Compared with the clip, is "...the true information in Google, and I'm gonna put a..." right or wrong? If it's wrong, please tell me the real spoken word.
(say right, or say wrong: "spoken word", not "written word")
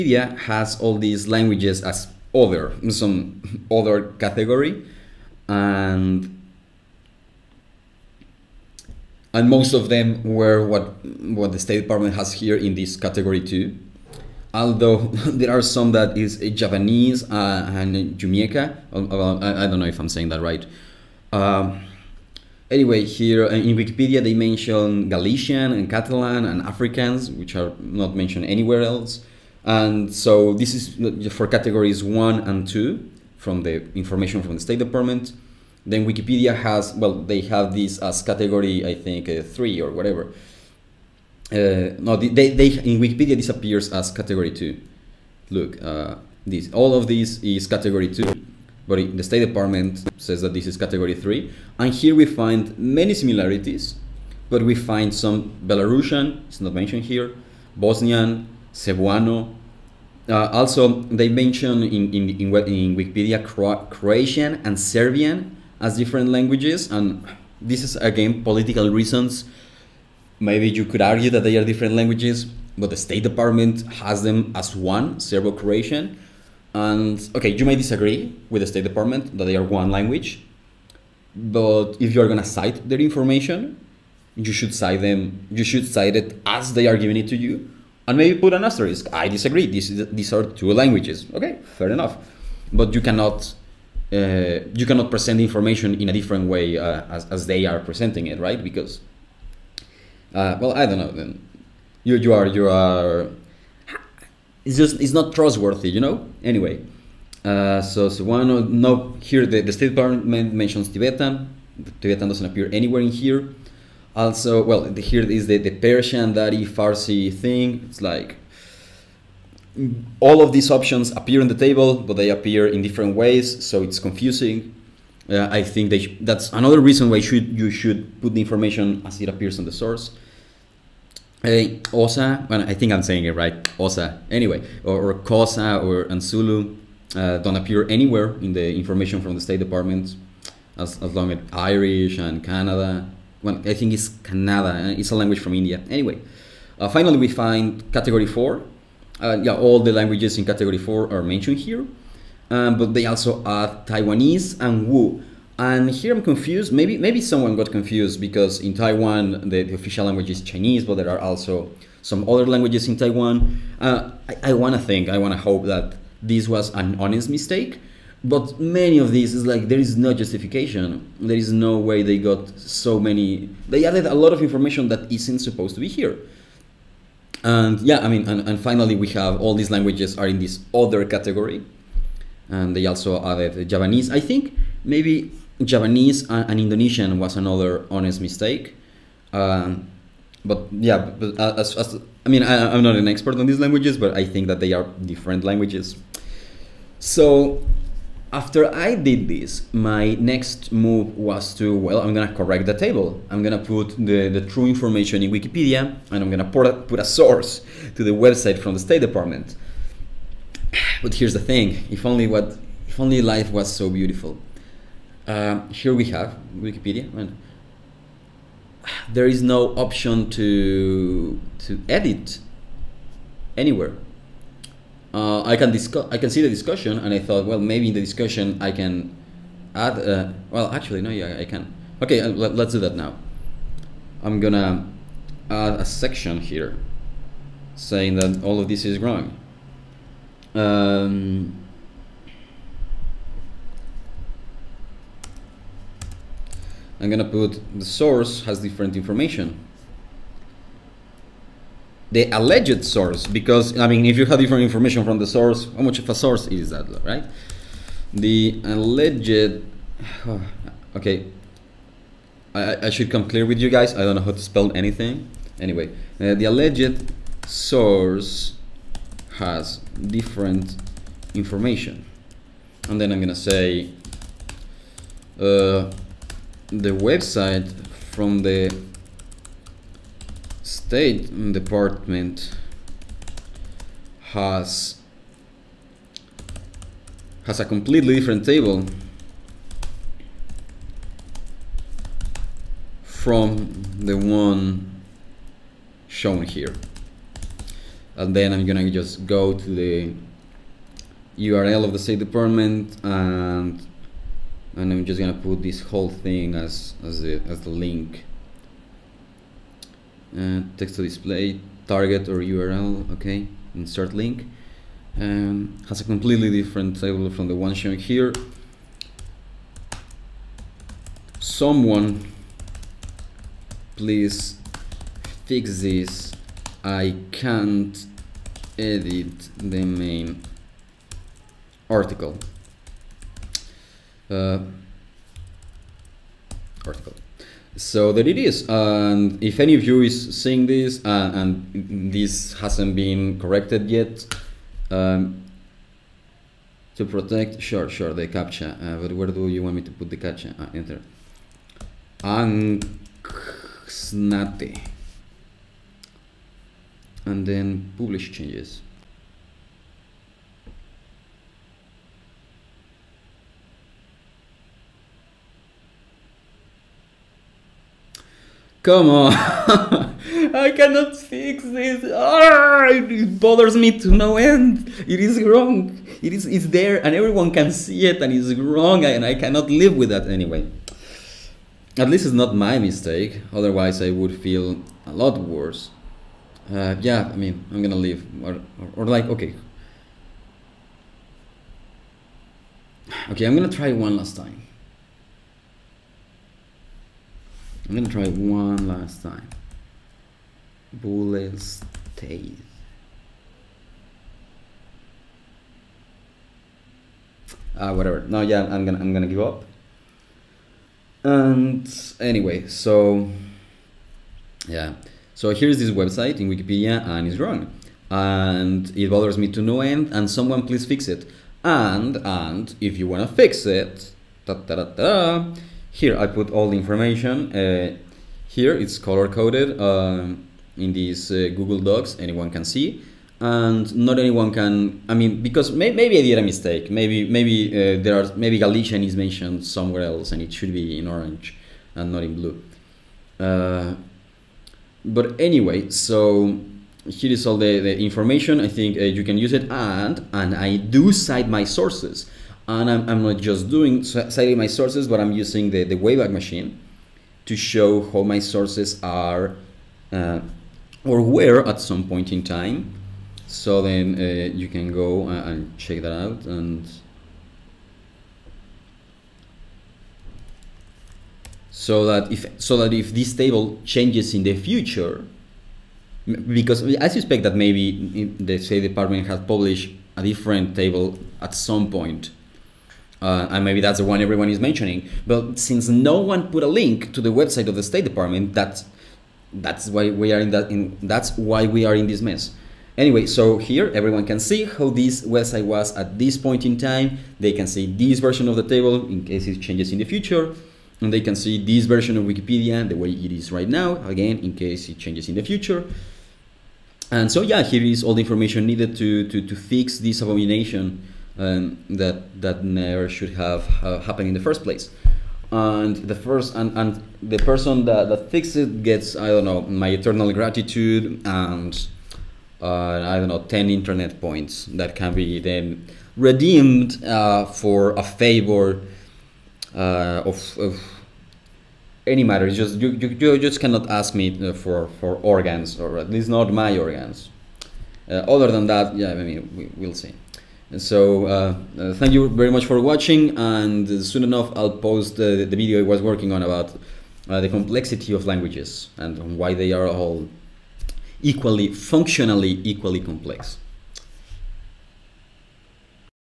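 wrong: "Wikipedia", not "Google".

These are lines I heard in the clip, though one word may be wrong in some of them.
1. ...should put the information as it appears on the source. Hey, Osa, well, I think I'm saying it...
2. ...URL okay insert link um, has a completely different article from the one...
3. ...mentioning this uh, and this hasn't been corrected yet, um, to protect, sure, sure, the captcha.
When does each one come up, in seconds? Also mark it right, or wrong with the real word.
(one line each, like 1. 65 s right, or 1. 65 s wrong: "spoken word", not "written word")
1. 127 s right
2. 312 s wrong: "table", not "article"
3. 340 s wrong: "seeing", not "mentioning".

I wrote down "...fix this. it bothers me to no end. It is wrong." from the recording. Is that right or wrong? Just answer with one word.
right.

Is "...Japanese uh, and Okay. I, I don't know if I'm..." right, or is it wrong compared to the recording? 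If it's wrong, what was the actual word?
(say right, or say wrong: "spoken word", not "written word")
wrong: "Jamaica", not "Okay".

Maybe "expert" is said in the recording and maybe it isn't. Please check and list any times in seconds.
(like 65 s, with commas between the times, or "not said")
193 s.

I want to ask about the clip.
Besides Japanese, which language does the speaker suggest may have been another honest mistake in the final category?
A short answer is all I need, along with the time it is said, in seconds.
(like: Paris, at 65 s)
Indonesian, at 186 s.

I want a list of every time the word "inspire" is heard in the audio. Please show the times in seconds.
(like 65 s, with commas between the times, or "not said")
not said.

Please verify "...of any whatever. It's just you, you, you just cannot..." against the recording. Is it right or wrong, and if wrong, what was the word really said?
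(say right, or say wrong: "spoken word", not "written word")
wrong: "matter", not "whatever".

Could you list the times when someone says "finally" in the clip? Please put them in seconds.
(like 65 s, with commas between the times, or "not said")
146 s, 178 s.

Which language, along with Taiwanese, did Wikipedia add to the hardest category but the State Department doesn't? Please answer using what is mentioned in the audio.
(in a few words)
Wu.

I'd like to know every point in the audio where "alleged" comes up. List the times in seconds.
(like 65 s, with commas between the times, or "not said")
252 s, 258 s, 266 s.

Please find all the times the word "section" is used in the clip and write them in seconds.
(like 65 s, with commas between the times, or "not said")
235 s.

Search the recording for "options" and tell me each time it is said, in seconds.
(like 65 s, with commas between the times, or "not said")
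120 s, 219 s.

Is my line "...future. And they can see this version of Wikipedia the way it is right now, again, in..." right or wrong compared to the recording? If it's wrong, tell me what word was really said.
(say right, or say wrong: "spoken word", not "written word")
right.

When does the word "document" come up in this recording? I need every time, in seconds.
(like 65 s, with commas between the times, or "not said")
not said.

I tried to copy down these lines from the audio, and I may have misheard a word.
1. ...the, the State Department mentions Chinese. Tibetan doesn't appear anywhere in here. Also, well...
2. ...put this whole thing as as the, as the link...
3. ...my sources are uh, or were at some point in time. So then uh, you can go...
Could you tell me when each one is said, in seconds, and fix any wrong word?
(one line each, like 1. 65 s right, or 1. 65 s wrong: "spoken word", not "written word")
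1. 109 s wrong: "Tibetan", not "Chinese"
2. 305 s right
3. 458 s right.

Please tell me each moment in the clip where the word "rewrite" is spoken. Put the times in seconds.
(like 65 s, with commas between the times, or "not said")
not said.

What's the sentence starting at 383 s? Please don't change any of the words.
Otherwise I would feel a lot worse.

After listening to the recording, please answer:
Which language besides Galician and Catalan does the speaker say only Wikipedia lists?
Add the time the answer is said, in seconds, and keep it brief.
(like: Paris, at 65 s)
Afrikaans, at 26 s.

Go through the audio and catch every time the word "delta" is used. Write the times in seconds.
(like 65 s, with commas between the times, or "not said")
not said.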